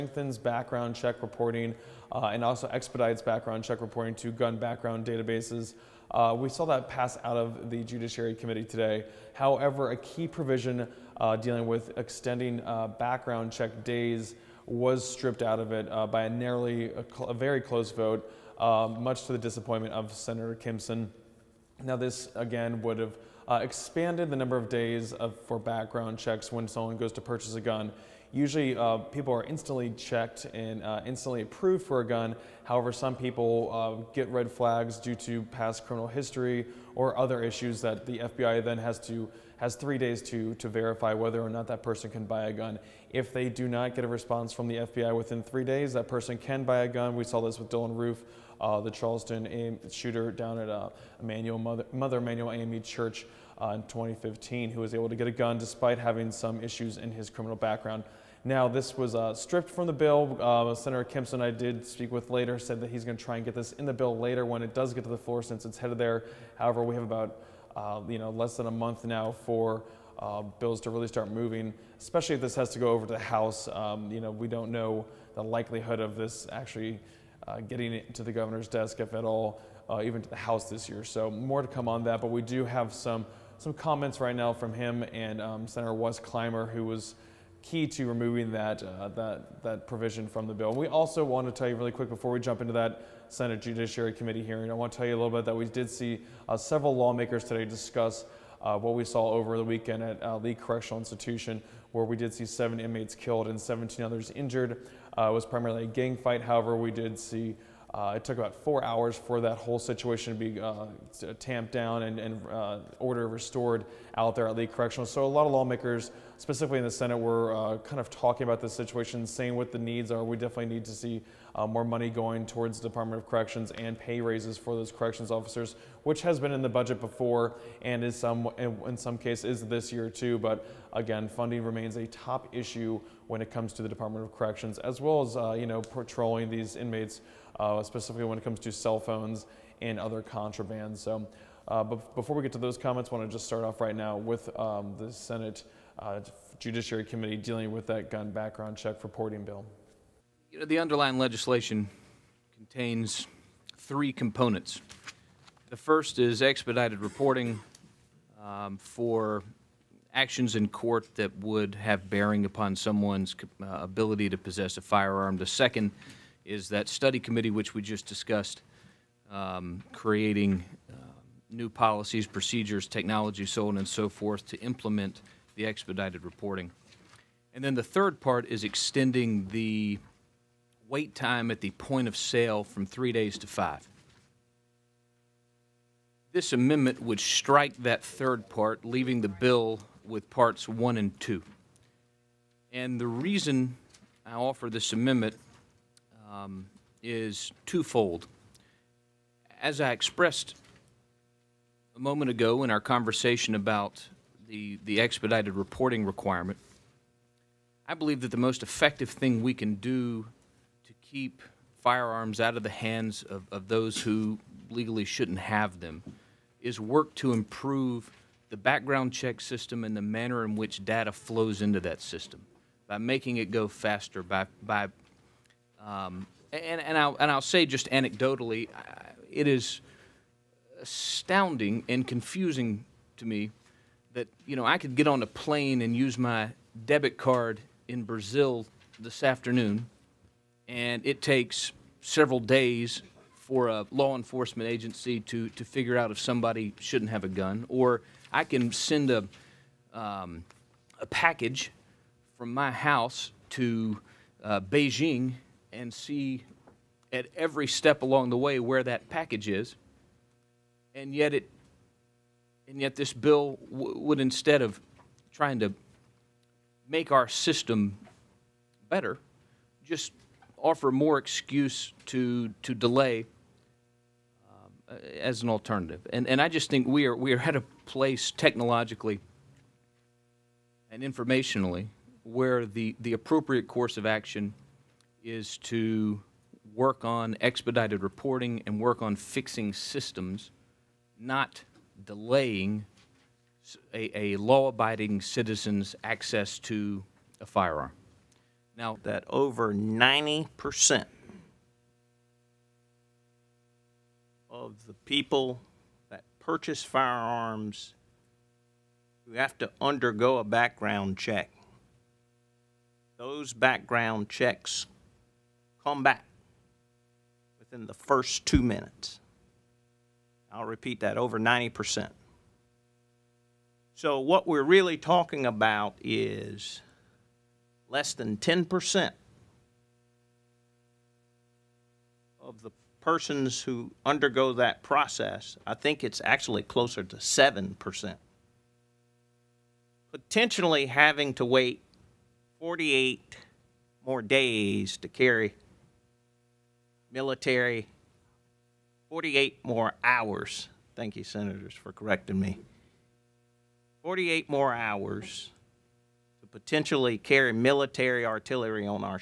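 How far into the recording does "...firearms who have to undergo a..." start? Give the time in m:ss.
5:06.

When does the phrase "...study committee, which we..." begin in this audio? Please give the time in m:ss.
2:46.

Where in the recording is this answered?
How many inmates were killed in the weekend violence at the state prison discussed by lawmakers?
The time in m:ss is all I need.
1:42.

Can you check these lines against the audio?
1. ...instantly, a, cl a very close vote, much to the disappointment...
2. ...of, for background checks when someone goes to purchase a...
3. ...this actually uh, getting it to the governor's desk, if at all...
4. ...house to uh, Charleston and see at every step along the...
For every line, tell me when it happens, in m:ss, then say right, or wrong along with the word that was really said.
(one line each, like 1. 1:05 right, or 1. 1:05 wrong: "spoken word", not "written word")
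1. 0:16 wrong: "narrowly", not "instantly"
2. 0:25 right
3. 1:16 right
4. 4:12 wrong: "Beijing", not "Charleston".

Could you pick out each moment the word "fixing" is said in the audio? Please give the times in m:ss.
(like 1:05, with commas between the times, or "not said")
4:49.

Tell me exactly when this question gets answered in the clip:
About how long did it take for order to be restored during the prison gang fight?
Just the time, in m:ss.
1:48.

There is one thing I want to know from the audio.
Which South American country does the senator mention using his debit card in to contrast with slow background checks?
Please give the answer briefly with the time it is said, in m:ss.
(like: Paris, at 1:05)
Brazil, at 3:58.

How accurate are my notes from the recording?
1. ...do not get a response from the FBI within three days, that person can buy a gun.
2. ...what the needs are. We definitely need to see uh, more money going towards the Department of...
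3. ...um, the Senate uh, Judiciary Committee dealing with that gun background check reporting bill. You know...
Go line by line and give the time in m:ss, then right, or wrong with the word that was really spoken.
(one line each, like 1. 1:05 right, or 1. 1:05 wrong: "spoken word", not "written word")
1. 0:43 right
2. 1:59 right
3. 2:24 right.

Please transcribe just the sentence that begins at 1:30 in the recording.
We also want to tell you really quick before we jump into that Senate Judiciary Committee hearing.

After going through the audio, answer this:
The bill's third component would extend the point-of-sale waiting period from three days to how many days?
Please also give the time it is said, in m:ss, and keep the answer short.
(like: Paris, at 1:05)
5, at 3:03.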